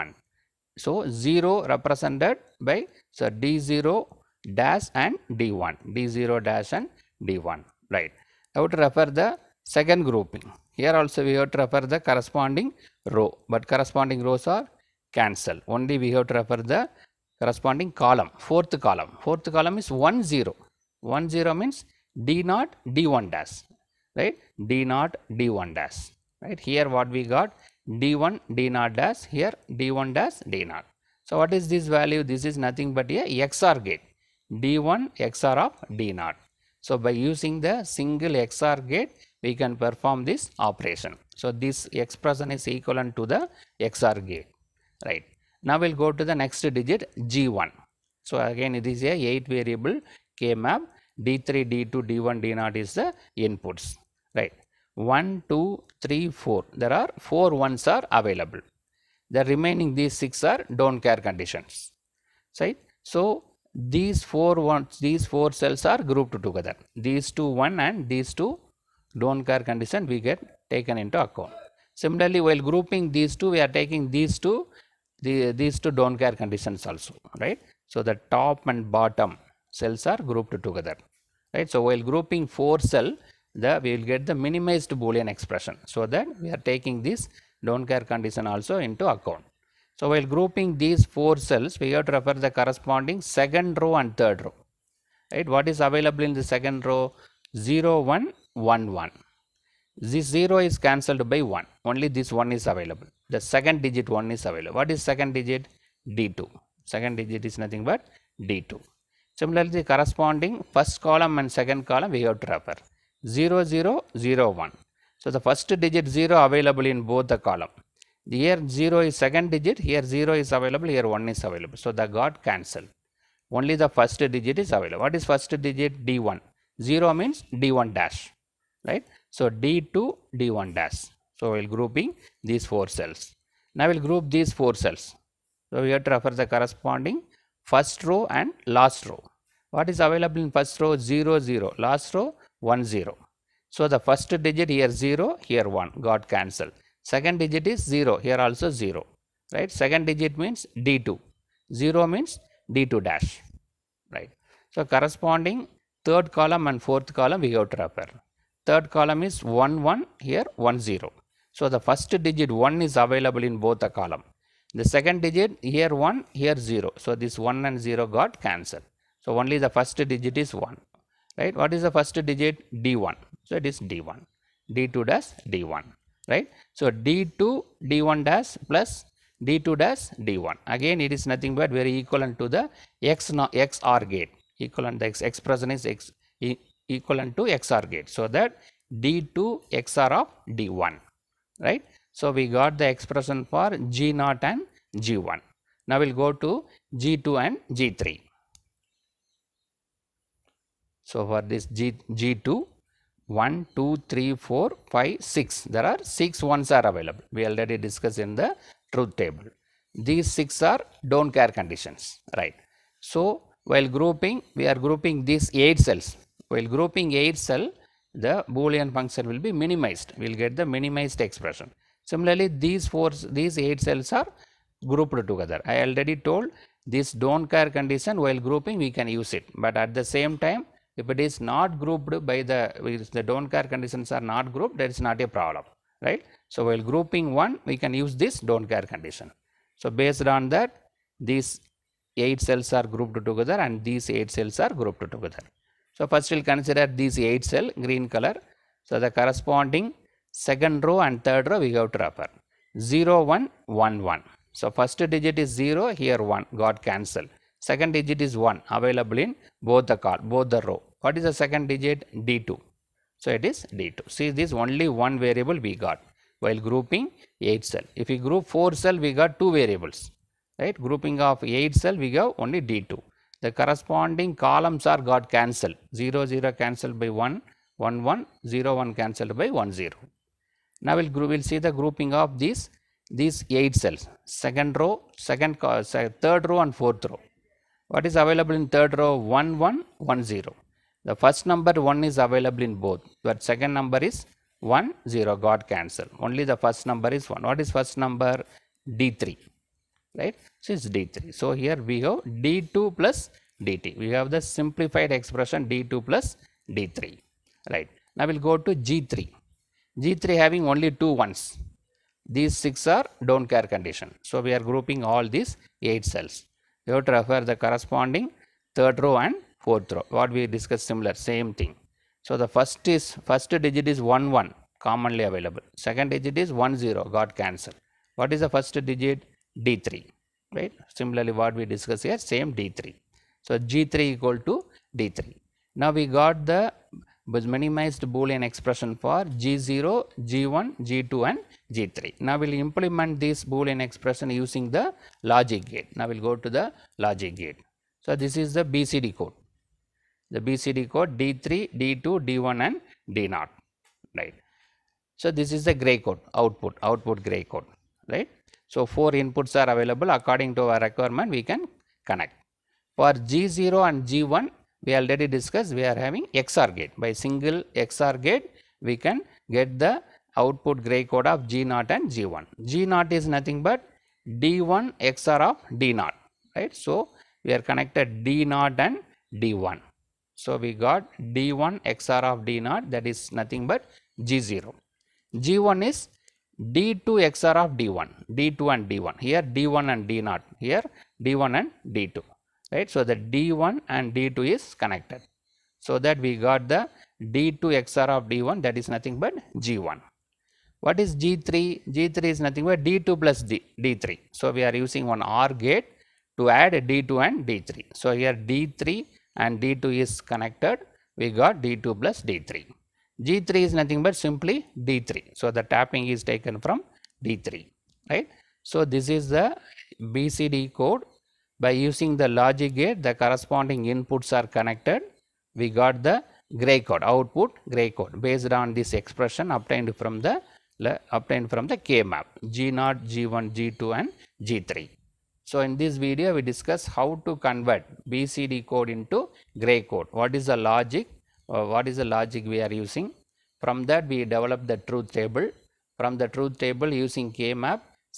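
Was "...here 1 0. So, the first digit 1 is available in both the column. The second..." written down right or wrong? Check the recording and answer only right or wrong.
right.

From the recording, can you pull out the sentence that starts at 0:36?
So by using the single XOR gate, we can perform this operation.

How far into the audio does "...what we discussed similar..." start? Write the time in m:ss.
5:20.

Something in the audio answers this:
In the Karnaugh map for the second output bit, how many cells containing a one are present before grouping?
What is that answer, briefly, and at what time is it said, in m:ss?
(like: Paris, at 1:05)
4, at 0:56.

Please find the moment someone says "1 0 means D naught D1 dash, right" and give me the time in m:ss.
0:21.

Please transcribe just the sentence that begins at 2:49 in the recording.
So, only the first digit is 1 right.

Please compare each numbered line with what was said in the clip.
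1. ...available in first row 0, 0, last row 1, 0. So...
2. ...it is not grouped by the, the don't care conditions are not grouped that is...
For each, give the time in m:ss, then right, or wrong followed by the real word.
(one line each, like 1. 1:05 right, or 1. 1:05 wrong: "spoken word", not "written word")
1. 2:20 right
2. 3:51 right.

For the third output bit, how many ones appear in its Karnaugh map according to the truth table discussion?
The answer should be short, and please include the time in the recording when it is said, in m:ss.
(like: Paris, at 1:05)
6, at 3:25.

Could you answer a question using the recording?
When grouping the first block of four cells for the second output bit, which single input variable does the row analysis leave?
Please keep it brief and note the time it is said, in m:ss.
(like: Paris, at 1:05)
D2, at 1:46.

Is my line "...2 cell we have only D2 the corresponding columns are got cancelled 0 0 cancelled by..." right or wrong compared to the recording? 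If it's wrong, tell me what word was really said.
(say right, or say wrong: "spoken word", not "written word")
wrong: "8", not "2".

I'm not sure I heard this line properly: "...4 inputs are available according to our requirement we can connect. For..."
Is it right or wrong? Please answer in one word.
right.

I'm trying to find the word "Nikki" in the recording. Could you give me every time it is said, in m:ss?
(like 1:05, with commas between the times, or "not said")
not said.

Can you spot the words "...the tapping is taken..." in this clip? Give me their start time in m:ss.
6:55.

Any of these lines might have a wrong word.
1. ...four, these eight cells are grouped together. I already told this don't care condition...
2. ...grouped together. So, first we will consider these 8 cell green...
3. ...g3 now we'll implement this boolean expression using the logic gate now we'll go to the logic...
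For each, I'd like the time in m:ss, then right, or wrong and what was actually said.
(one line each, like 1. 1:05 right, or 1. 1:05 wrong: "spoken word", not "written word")
1. 3:42 right
2. 4:04 right
3. 5:41 right.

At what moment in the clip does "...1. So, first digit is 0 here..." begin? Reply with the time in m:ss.
4:14.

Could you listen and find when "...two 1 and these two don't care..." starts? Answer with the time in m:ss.
1:07.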